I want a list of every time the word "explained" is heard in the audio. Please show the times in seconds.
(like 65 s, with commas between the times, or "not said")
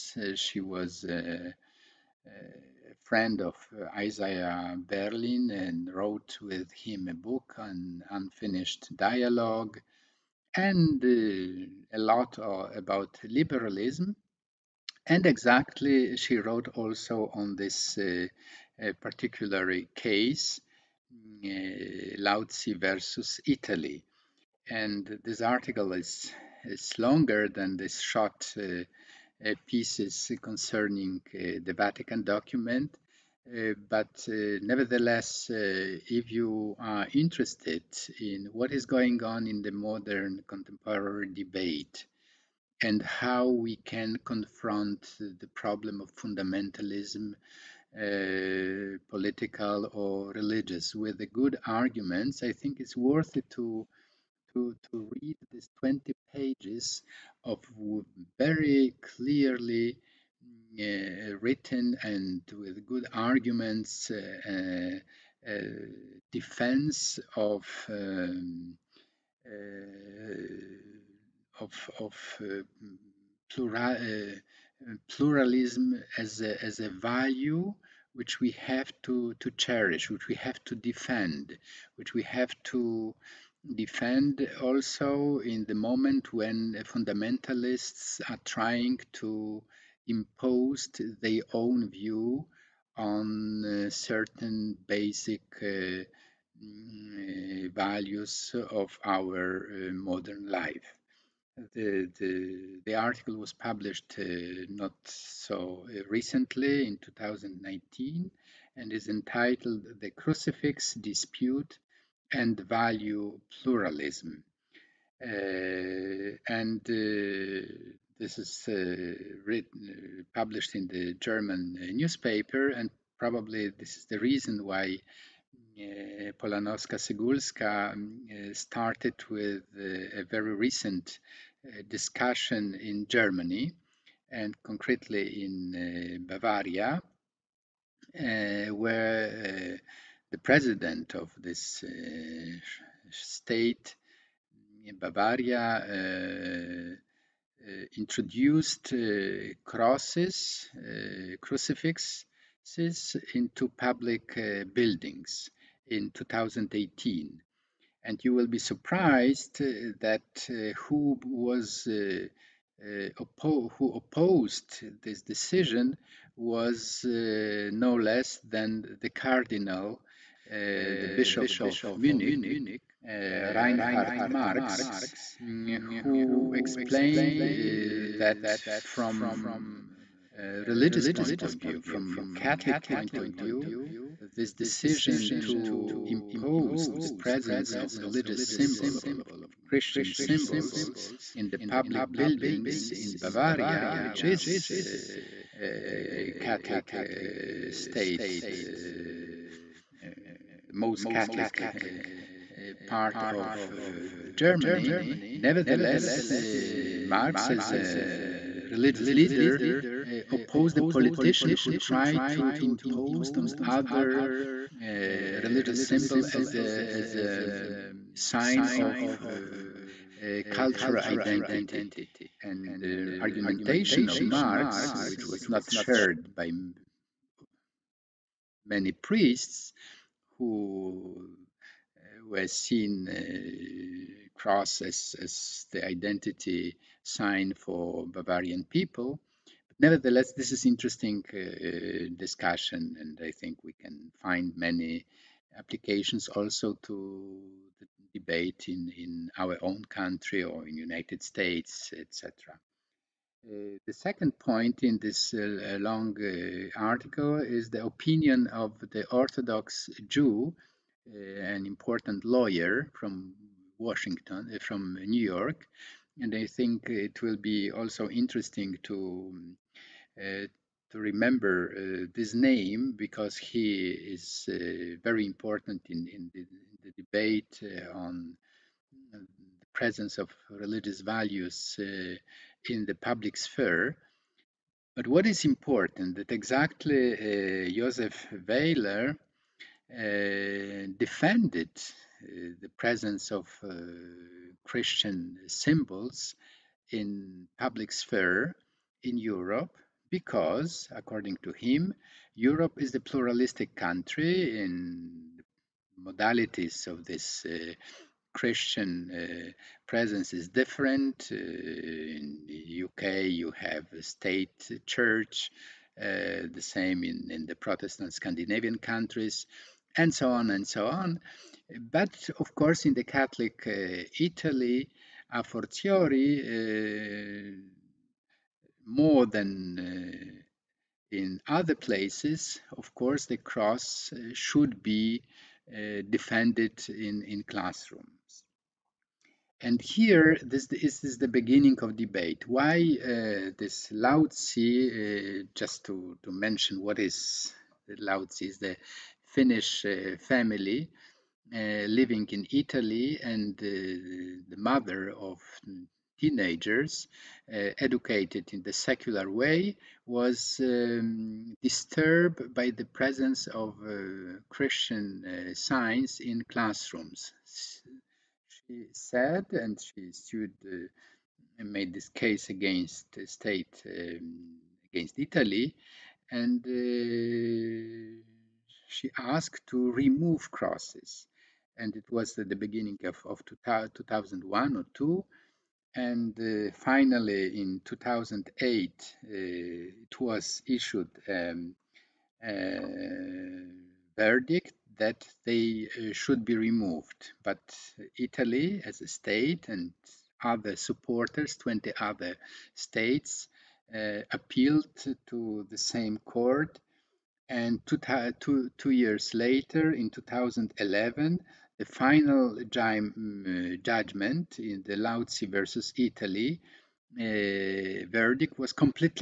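176 s.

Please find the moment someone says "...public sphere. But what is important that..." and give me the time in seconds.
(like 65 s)
282 s.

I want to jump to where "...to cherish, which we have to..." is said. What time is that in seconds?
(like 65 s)
79 s.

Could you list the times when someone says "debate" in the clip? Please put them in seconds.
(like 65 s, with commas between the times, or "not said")
41 s, 248 s, 277 s, 341 s.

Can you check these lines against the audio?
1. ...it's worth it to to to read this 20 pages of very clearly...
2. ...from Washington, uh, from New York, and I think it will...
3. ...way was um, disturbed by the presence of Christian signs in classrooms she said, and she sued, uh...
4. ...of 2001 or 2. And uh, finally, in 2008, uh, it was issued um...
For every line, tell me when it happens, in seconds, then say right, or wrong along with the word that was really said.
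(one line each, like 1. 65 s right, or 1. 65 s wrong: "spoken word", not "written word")
1. 52 s right
2. 262 s right
3. 359 s right
4. 383 s right.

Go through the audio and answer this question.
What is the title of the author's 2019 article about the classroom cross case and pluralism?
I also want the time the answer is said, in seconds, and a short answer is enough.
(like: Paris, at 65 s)
The Crucifix Dispute and value pluralism, at 109 s.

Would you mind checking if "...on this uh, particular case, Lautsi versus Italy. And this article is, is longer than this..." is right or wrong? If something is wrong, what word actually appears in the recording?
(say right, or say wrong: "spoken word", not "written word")
right.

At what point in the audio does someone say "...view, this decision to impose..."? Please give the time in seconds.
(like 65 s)
183 s.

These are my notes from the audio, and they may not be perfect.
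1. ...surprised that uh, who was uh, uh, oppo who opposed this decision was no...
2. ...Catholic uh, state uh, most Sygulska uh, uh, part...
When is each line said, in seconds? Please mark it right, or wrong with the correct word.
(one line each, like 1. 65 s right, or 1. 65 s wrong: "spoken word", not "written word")
1. 158 s right
2. 196 s wrong: "Catholic", not "Sygulska".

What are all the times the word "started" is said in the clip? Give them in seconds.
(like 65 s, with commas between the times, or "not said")
128 s.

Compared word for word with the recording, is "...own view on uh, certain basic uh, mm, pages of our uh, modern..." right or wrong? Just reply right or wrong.
wrong.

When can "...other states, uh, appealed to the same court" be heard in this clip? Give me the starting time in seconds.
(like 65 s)
401 s.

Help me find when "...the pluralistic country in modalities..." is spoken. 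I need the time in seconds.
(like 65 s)
302 s.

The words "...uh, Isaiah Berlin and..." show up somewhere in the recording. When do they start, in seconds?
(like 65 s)
3 s.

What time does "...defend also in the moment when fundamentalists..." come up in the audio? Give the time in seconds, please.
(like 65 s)
83 s.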